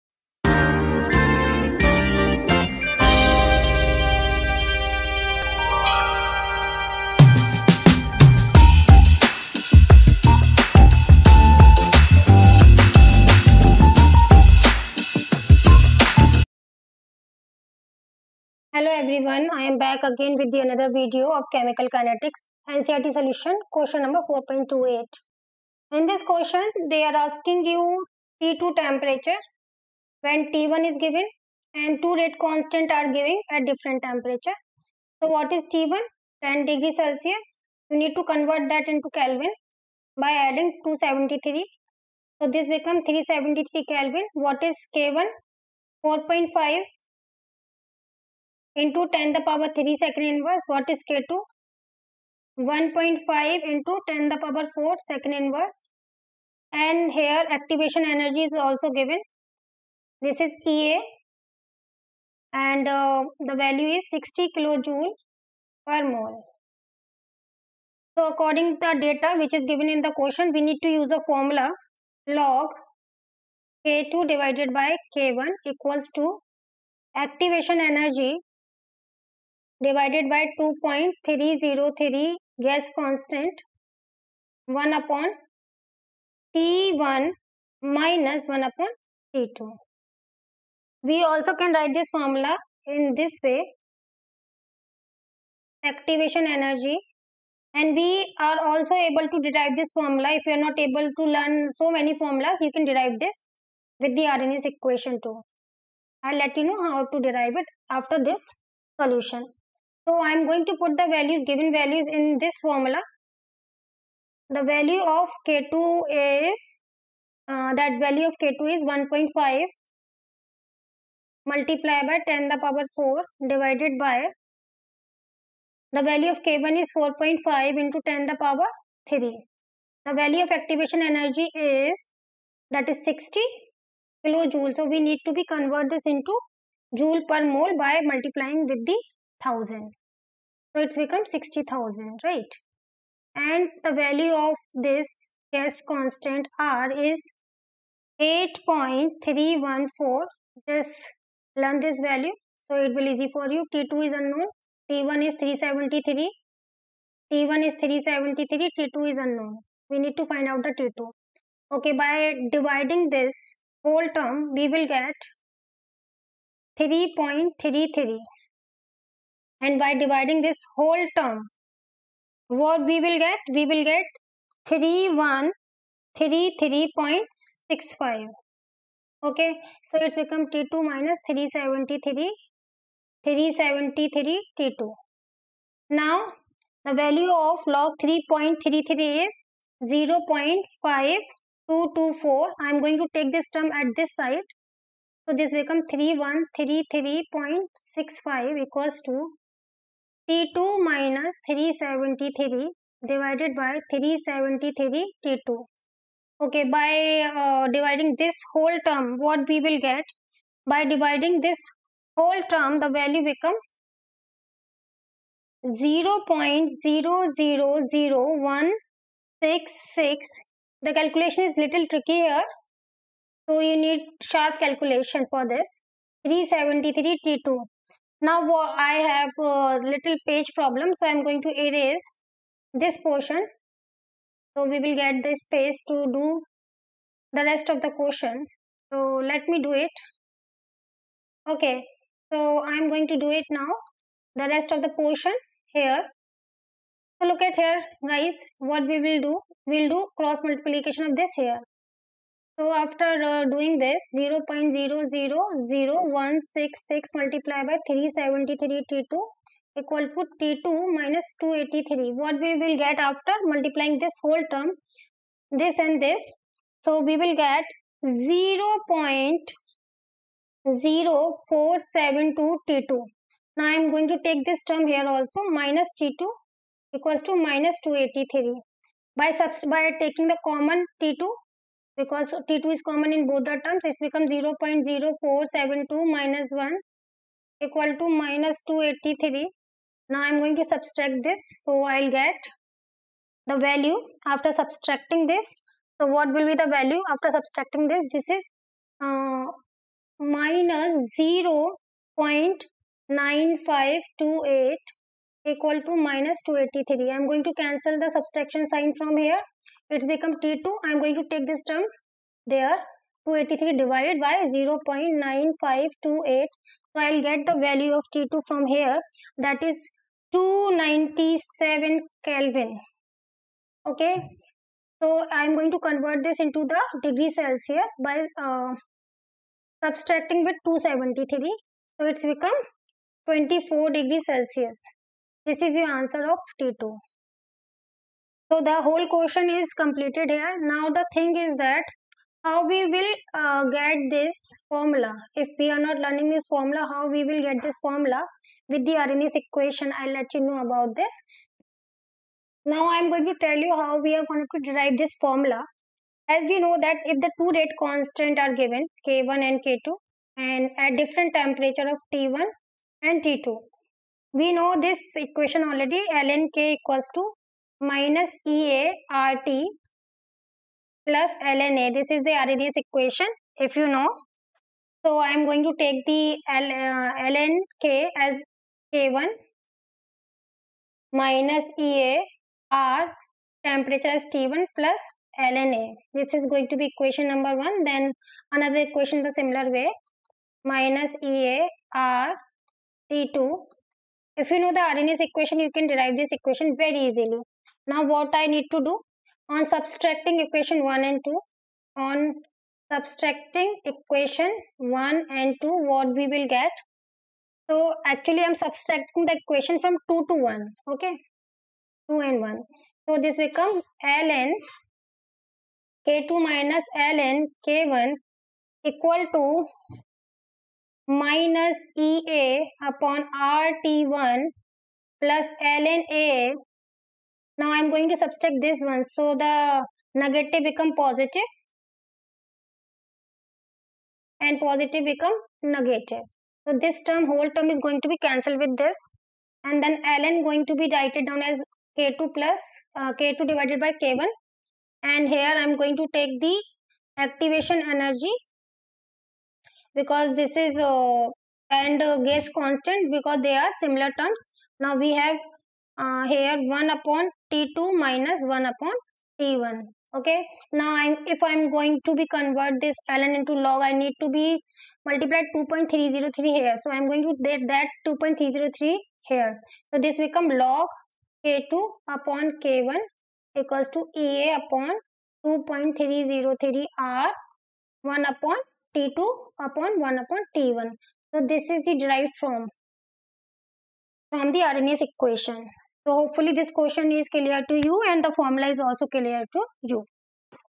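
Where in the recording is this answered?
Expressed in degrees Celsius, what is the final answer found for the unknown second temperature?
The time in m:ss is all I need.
5:33.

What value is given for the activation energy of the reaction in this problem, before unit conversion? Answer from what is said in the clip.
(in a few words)
60 kilojoule per mole.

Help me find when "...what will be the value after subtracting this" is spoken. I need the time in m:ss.
4:56.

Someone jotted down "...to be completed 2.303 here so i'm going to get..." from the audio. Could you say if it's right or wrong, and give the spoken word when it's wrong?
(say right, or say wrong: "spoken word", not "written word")
wrong: "multiplied", not "completed".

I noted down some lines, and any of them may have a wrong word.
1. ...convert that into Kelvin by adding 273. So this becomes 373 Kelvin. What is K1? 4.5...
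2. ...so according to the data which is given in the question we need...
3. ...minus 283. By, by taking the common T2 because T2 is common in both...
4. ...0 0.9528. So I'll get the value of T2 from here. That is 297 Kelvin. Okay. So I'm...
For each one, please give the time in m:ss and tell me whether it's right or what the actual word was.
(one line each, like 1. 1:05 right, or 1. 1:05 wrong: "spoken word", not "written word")
1. 0:38 right
2. 1:08 right
3. 4:37 right
4. 5:14 right.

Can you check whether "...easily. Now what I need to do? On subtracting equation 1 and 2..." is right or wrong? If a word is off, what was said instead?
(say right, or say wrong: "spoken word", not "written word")
right.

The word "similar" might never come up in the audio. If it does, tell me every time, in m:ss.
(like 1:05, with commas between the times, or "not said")
6:29, 7:33.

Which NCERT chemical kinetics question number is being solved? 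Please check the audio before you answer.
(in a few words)
4.28.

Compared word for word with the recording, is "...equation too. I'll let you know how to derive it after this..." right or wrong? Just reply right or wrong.
right.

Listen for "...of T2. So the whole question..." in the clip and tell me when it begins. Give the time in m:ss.
5:36.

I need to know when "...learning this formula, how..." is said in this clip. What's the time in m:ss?
5:45.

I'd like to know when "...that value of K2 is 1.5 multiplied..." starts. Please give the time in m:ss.
1:57.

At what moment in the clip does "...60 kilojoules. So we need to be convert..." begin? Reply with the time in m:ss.
2:13.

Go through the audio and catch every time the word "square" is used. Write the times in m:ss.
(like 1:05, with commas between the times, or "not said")
not said.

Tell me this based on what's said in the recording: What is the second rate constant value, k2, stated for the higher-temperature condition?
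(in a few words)
1.5 × 10^4 per second.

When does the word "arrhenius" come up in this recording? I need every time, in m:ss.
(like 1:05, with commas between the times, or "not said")
1:44, 5:48, 6:12, 6:34, 8:04.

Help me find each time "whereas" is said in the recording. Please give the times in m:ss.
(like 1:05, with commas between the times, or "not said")
not said.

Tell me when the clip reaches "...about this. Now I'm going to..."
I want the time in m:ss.
5:50.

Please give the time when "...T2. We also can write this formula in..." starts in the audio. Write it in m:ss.
1:29.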